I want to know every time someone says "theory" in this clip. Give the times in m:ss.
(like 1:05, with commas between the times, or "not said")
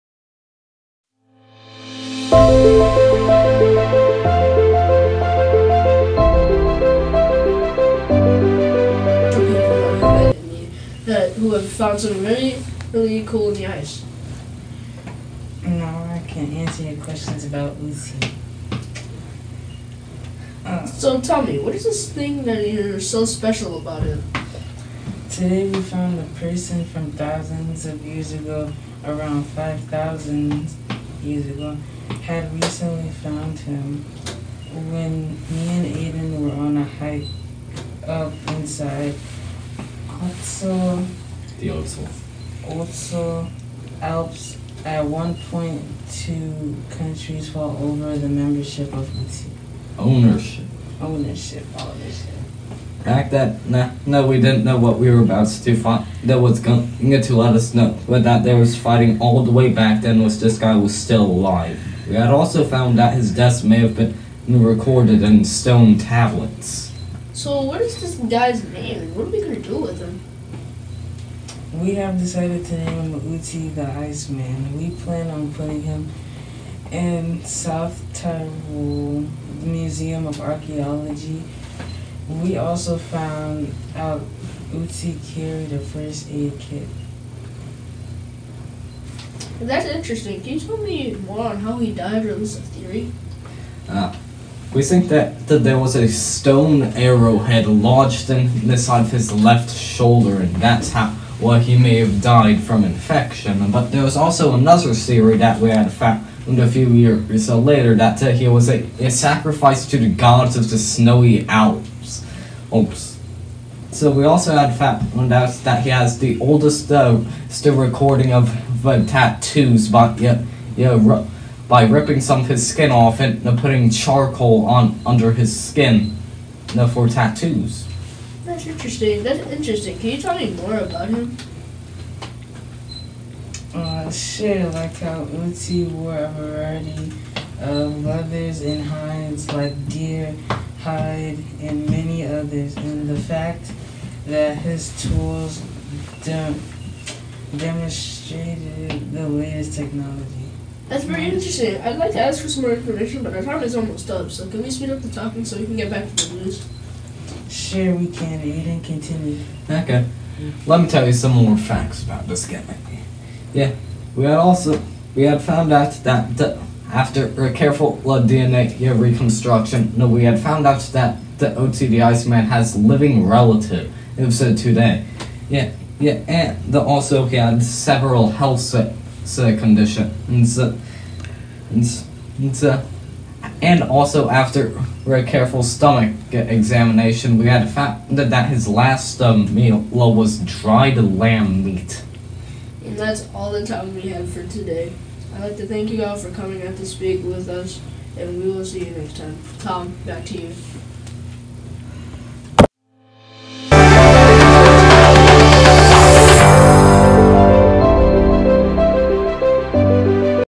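1:32, 1:44.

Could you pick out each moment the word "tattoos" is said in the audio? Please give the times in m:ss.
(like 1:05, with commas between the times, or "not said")
1:59, 2:07.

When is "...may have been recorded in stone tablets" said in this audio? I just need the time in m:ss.
1:03.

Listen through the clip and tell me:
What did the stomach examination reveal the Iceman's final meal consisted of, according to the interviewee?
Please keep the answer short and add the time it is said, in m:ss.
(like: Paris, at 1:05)
Dried lamb meat, at 3:10.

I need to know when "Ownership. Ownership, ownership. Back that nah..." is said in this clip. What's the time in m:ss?
0:49.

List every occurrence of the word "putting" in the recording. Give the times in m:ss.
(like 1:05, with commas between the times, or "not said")
1:15, 2:03.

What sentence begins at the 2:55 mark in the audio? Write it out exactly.
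Yeah, yeah, and the, also he had several health conditions.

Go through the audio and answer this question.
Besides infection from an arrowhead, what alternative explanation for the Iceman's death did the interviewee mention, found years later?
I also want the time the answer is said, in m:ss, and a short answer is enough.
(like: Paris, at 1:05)
Sacrifice to the gods, at 1:48.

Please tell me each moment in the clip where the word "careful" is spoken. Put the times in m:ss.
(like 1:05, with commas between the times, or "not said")
2:47, 3:05.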